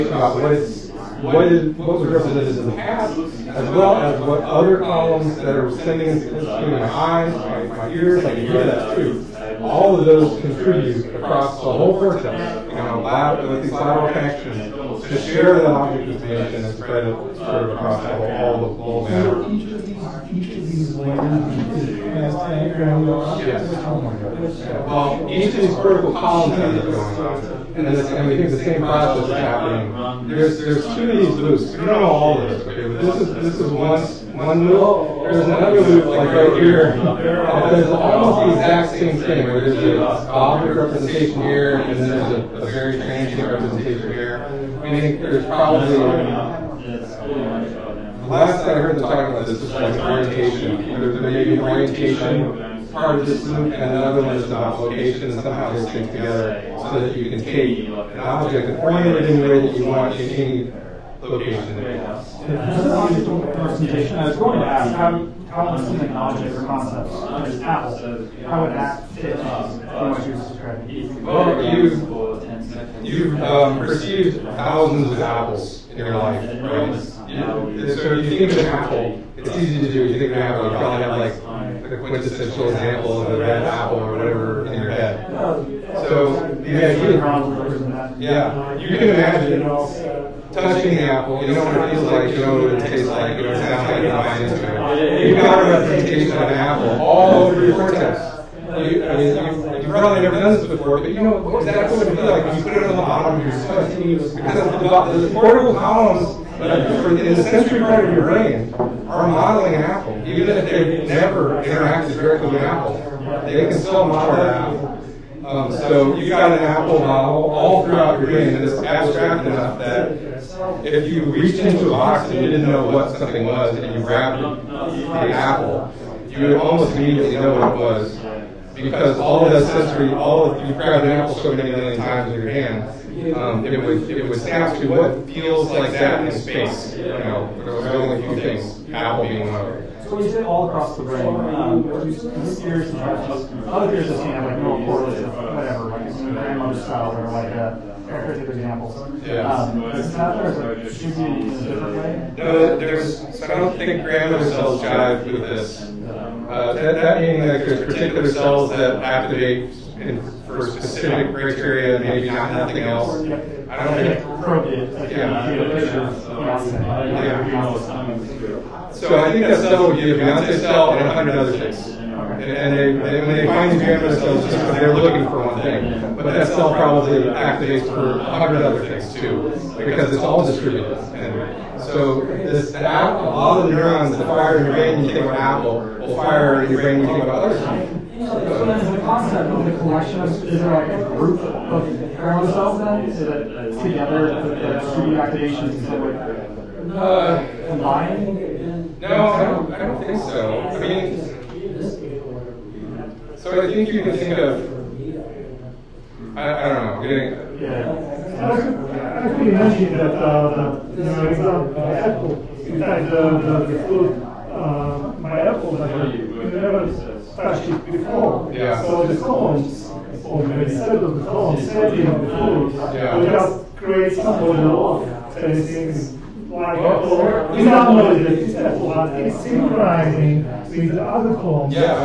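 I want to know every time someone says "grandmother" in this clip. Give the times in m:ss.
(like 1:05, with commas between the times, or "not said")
2:26, 2:34.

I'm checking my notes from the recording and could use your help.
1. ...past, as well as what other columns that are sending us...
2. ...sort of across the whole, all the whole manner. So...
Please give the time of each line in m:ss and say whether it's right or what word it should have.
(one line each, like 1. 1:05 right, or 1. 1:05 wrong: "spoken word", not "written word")
1. 0:02 right
2. 0:17 right.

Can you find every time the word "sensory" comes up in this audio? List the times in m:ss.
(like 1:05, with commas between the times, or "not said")
1:47, 2:09.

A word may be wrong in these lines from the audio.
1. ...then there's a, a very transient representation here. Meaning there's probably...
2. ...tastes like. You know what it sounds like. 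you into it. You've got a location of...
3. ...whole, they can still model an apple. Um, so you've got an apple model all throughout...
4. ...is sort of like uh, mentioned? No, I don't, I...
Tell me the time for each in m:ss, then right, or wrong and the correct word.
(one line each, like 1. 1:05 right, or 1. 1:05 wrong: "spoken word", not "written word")
1. 0:41 right
2. 1:32 wrong: "representation", not "location"
3. 1:52 wrong: "apple", not "whole"
4. 3:15 wrong: "combined", not "mentioned".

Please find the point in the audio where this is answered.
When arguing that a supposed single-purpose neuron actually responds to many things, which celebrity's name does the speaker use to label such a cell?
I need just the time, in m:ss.
2:50.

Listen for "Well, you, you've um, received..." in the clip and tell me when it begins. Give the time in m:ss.
1:11.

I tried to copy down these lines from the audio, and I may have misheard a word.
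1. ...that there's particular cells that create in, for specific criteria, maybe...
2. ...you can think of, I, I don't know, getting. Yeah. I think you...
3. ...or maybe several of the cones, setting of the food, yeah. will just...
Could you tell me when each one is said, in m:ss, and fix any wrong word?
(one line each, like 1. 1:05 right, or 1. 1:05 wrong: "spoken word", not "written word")
1. 2:37 wrong: "activate", not "create"
2. 3:23 right
3. 3:40 right.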